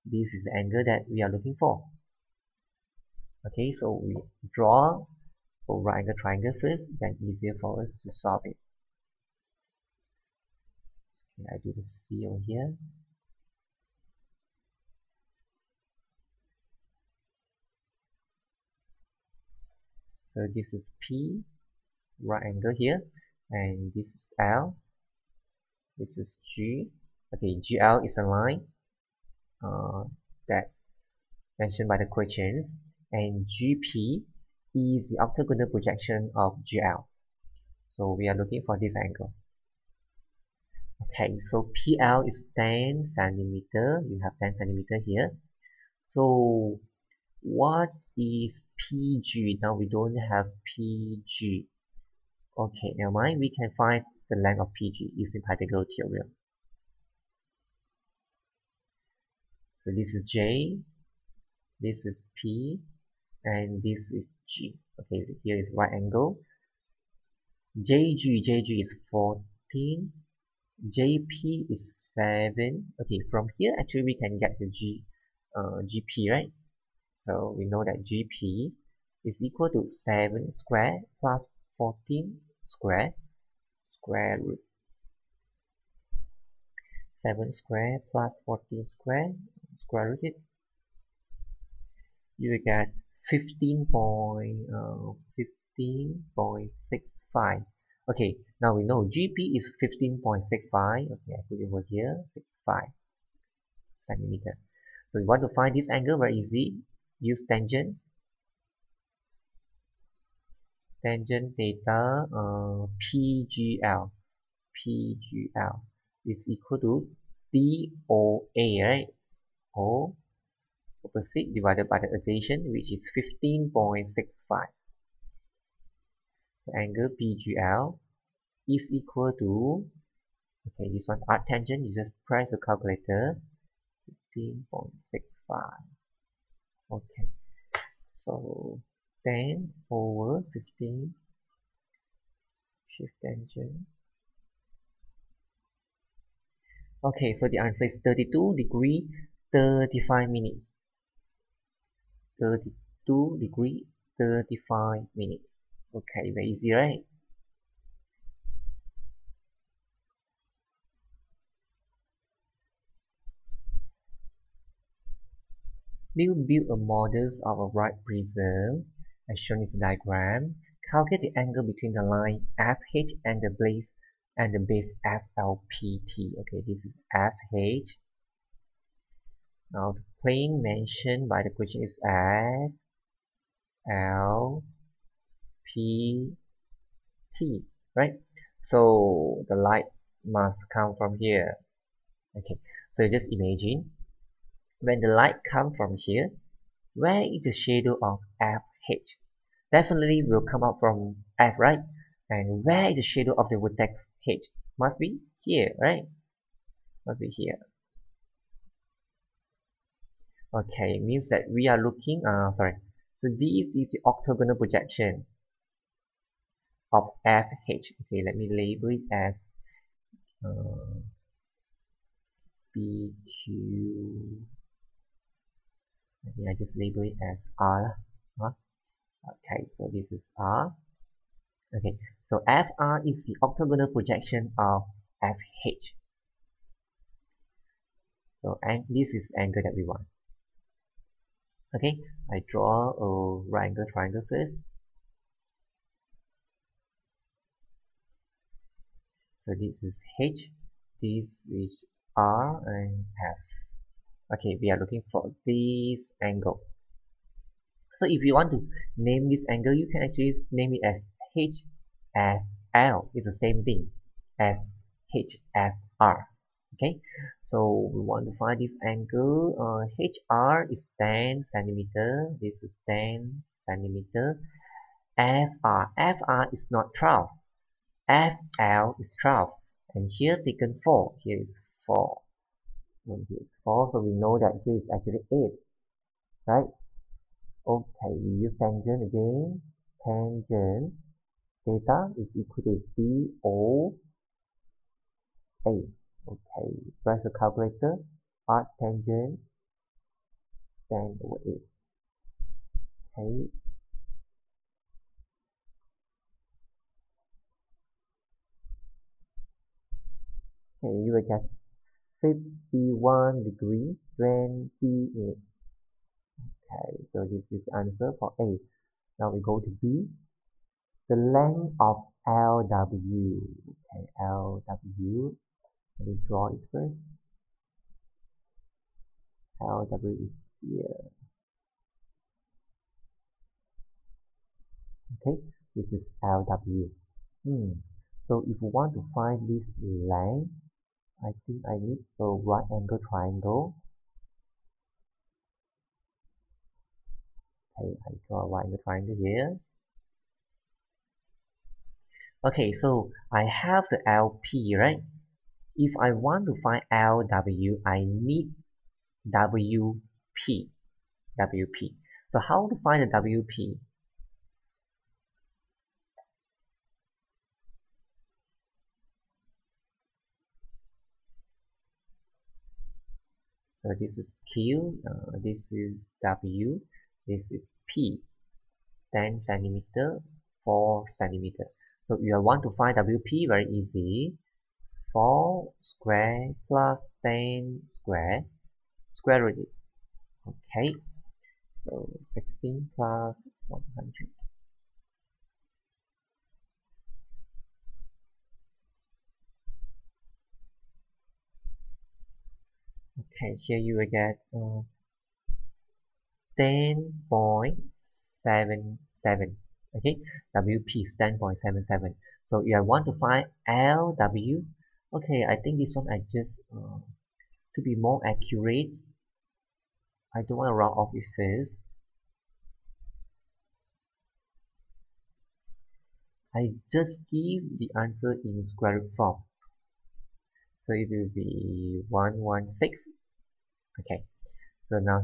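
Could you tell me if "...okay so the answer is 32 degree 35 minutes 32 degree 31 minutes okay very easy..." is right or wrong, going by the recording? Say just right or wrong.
wrong.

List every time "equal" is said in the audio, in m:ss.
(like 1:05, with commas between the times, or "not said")
1:19, 1:56, 2:08, 4:52.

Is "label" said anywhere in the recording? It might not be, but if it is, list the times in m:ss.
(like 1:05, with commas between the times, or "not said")
3:38, 3:46.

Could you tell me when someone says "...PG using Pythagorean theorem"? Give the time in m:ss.
0:54.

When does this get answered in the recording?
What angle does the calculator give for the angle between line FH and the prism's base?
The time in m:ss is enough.
5:12.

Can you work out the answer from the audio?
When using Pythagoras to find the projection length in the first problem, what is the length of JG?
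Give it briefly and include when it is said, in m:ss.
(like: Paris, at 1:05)
14, at 1:08.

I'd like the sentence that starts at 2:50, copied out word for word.
Calculate the angle between the line FH and the base and the base FLPT.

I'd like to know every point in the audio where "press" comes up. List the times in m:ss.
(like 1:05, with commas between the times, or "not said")
2:12, 4:57.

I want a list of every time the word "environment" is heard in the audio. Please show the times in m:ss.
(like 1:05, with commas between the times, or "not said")
not said.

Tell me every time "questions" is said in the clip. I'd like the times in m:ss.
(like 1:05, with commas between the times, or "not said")
0:32, 3:01.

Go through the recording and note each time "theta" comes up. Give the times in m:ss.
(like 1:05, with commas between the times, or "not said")
1:51, 4:51.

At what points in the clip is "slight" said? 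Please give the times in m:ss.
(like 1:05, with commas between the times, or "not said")
not said.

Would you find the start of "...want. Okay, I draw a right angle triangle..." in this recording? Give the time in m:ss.
3:59.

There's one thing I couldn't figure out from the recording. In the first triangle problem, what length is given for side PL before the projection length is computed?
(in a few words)
10 centimeter.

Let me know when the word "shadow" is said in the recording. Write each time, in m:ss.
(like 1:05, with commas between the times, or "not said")
3:17, 3:23.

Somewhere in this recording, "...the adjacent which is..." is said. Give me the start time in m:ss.
2:01.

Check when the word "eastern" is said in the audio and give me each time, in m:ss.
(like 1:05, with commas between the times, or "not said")
not said.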